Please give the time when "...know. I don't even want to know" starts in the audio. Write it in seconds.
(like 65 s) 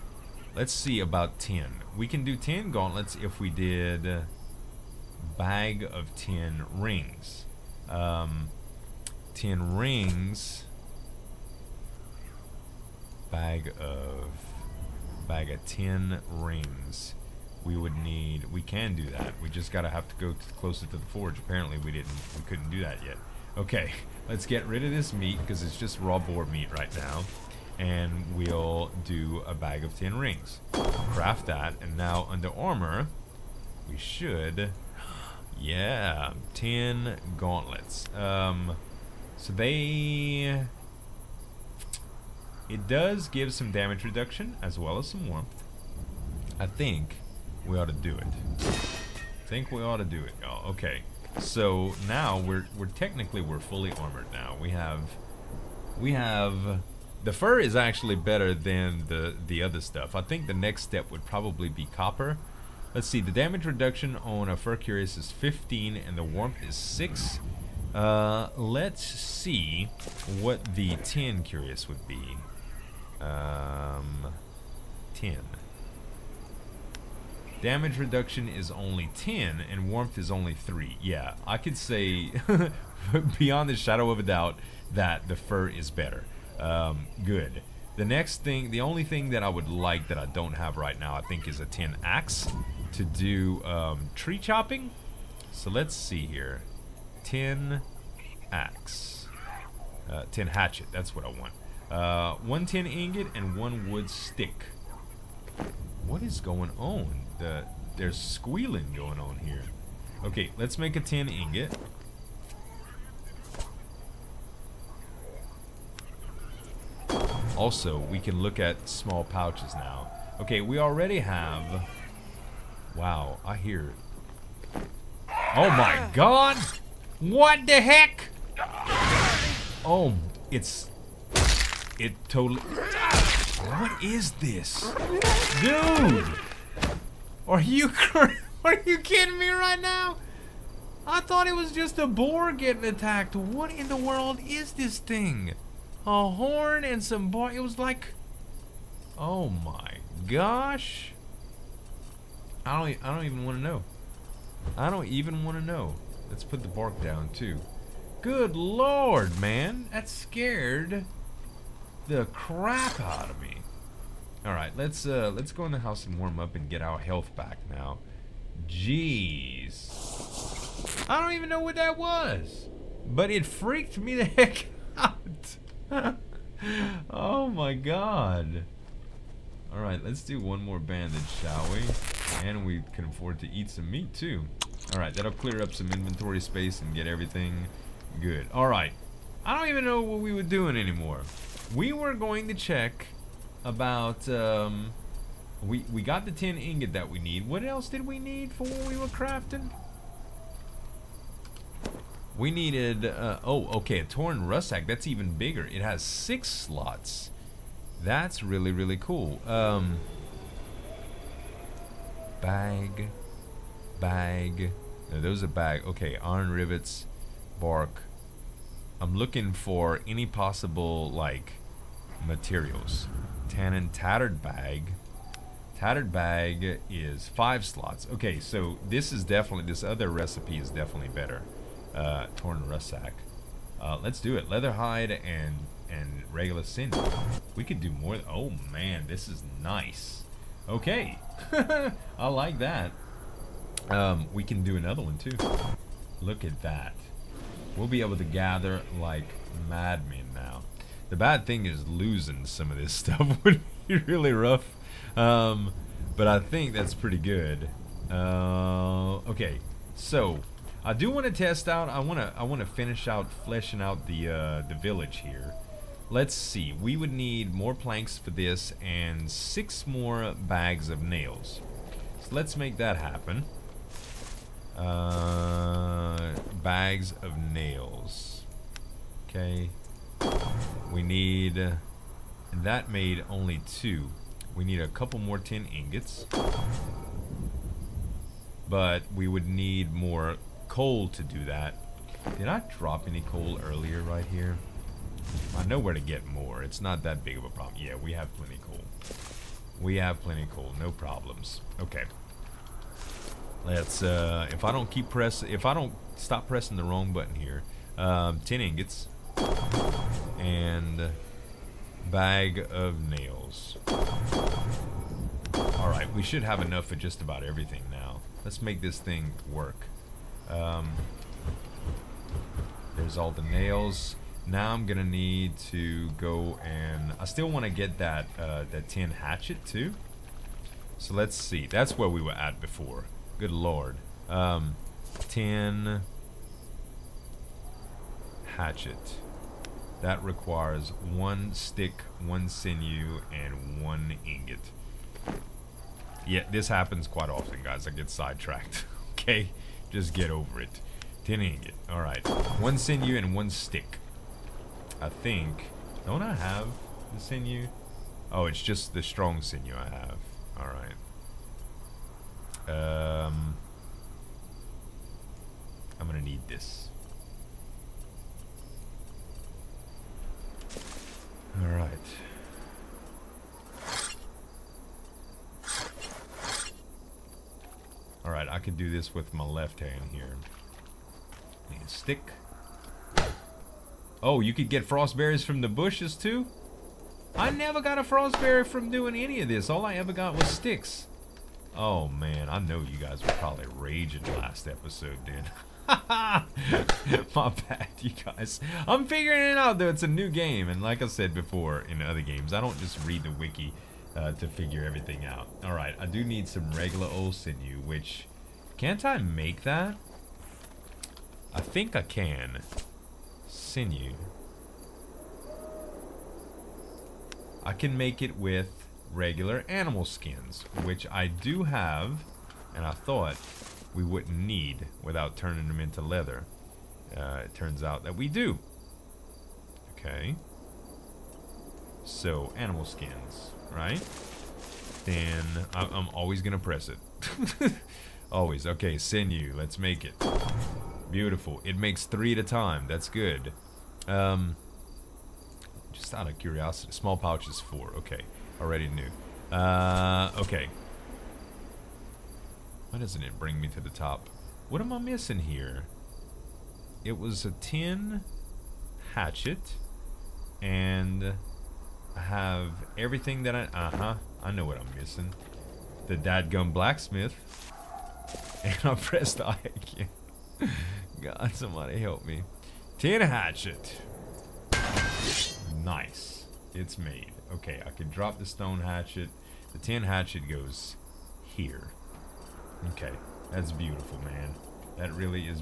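153 s.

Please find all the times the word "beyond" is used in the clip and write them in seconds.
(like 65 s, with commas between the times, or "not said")
83 s.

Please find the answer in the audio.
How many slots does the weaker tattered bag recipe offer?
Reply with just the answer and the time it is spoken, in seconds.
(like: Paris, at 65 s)
5, at 227 s.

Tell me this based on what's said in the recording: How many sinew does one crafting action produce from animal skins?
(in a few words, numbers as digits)
3.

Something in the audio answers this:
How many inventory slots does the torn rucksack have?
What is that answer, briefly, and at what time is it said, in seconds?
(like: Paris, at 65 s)
6, at 206 s.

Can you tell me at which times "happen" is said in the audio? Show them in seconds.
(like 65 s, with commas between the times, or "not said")
272 s, 346 s.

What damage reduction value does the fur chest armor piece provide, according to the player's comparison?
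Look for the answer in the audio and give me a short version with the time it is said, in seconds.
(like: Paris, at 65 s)
15, at 65 s.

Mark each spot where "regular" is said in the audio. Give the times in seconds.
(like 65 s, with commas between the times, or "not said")
236 s, 406 s, 419 s.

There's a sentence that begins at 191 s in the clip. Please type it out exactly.
We were going to check about, um, we, we got the tin ingot that we need.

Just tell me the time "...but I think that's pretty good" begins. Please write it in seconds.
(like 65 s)
256 s.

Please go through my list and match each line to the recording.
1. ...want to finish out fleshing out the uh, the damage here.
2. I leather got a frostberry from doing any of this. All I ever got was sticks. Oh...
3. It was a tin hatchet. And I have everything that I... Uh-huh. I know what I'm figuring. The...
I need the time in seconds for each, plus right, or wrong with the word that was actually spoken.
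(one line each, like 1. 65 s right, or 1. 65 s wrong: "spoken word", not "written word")
1. 262 s wrong: "village", not "damage"
2. 387 s wrong: "never", not "leather"
3. 457 s wrong: "missing", not "figuring".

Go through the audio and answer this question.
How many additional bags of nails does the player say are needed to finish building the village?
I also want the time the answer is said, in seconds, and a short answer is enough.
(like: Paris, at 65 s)
6, at 269 s.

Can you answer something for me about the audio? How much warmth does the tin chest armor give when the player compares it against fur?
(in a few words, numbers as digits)
3.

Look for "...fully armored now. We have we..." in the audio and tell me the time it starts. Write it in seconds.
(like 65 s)
53 s.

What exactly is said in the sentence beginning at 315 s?
All right, we should have enough for just about everything now.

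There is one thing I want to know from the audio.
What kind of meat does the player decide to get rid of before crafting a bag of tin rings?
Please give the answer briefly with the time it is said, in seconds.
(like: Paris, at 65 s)
raw boar meat, at 25 s.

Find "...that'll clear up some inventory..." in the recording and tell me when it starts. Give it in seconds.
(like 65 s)
185 s.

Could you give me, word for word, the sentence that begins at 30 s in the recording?
Craft that, and now under armor, we should.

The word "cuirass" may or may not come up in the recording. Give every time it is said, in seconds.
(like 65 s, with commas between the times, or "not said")
64 s, 71 s.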